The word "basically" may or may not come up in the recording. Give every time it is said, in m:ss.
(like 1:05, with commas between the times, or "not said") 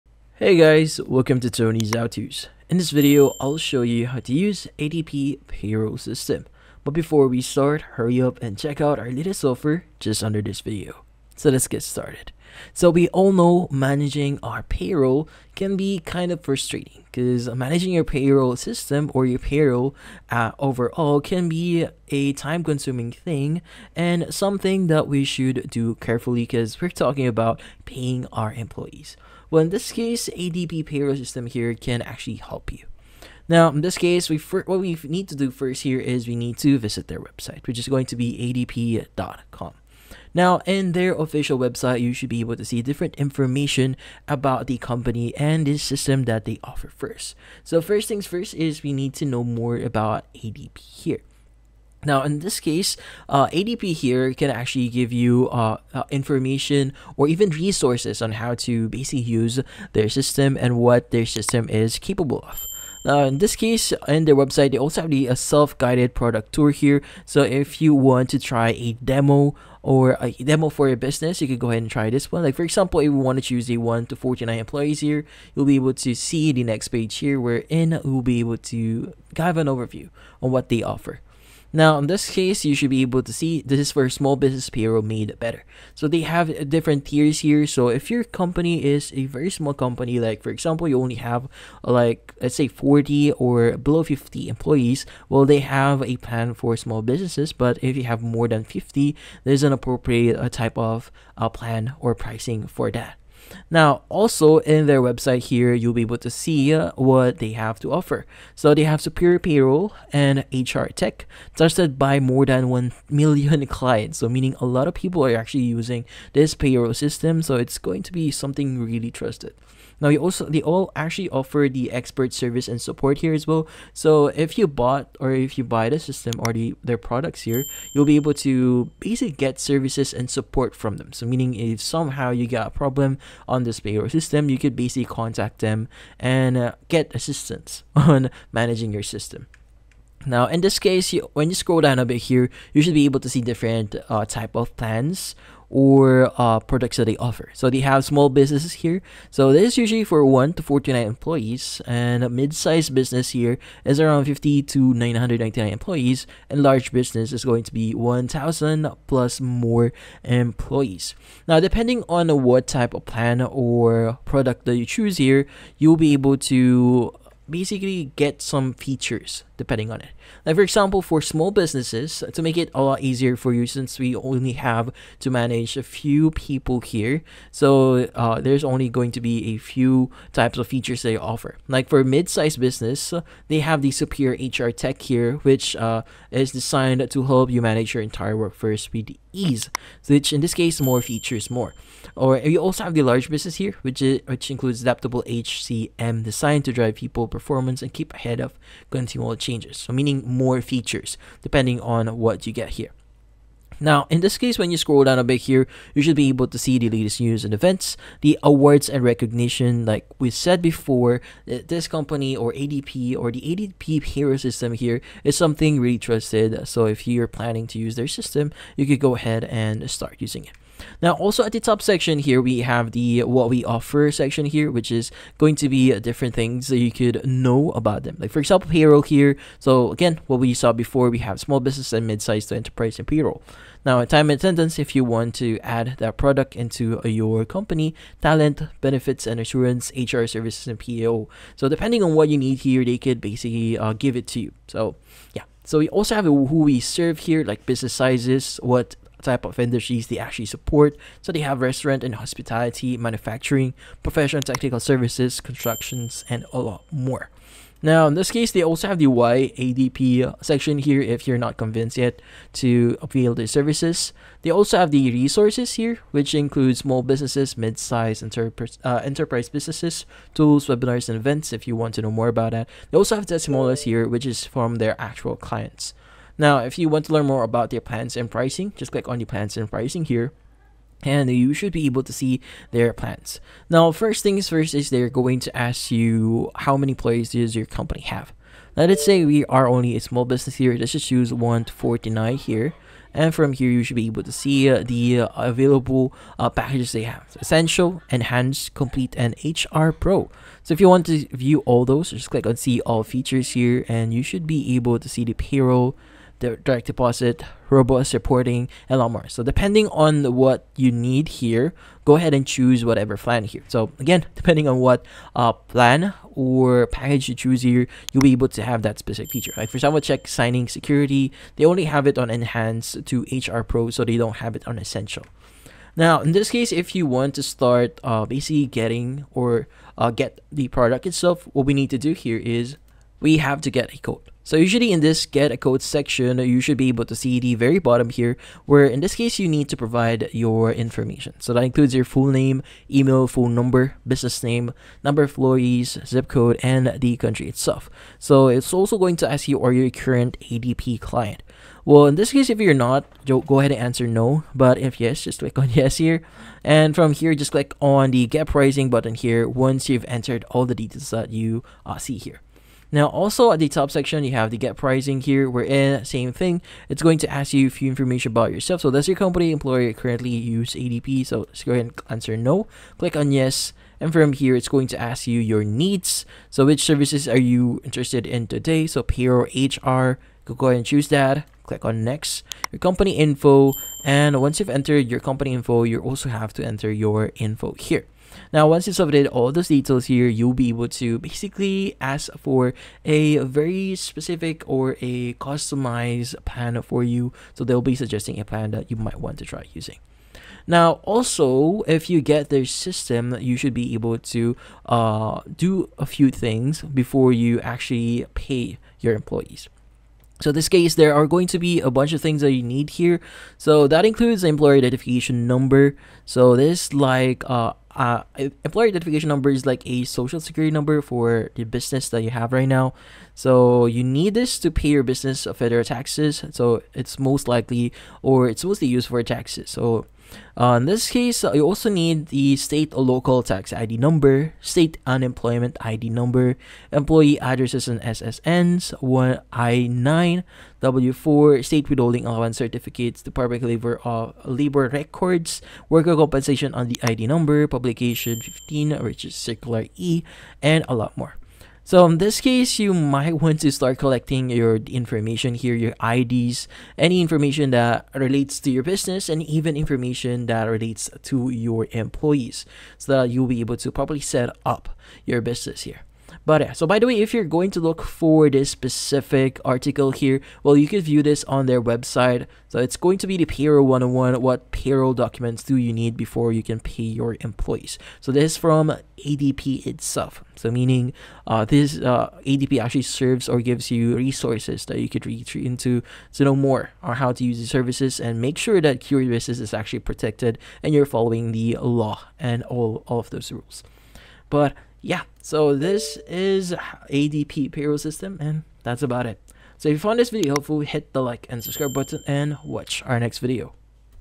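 0:58, 2:08, 2:14, 2:47, 4:03, 5:28, 6:31.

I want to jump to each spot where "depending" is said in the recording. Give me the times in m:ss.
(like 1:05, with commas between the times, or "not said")
2:41, 2:49, 3:21, 4:01, 5:09, 5:14.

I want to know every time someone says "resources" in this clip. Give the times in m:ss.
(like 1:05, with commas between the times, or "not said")
0:57, 4:25, 8:04.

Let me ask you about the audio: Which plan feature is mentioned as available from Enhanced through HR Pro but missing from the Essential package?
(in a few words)
check signing security.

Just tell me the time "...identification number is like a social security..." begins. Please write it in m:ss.
6:58.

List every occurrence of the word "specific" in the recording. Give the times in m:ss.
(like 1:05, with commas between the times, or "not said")
5:18, 6:33, 7:48.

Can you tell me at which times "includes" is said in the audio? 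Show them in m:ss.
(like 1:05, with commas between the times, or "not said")
3:14, 4:26, 5:41, 6:54.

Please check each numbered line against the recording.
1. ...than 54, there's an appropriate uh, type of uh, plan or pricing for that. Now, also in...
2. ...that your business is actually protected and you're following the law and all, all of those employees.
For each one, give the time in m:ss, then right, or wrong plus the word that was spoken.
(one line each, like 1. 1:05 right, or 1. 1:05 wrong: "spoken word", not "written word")
1. 1:38 wrong: "50", not "54"
2. 8:08 wrong: "rules", not "employees".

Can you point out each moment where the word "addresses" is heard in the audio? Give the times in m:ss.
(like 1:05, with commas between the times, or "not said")
7:17.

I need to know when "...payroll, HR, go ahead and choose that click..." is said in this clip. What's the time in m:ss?
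6:19.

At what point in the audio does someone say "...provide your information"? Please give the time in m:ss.
5:39.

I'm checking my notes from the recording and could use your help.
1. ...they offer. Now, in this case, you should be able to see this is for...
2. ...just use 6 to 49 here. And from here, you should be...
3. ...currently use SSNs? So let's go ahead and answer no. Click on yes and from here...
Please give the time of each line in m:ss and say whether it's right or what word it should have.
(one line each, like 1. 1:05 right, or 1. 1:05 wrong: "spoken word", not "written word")
1. 1:20 right
2. 4:50 wrong: "1", not "6"
3. 6:09 wrong: "ADP", not "SSNs".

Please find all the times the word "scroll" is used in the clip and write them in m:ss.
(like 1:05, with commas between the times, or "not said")
2:21, 3:24.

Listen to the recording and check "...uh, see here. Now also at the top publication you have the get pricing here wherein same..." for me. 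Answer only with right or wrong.
wrong.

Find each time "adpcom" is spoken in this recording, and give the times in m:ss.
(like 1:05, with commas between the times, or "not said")
0:38.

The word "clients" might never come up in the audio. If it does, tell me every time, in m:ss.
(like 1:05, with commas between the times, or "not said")
1:53, 4:35, 5:50.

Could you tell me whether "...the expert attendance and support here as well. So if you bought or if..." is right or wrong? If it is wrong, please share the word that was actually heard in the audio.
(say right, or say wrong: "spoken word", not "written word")
wrong: "service", not "attendance".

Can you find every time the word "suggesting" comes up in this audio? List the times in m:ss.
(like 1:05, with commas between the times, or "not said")
6:37.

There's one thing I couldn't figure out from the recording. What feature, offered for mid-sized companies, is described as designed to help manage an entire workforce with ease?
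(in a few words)
Superior HR Tech.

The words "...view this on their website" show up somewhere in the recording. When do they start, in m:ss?
7:51.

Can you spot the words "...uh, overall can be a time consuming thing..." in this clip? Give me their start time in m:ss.
0:20.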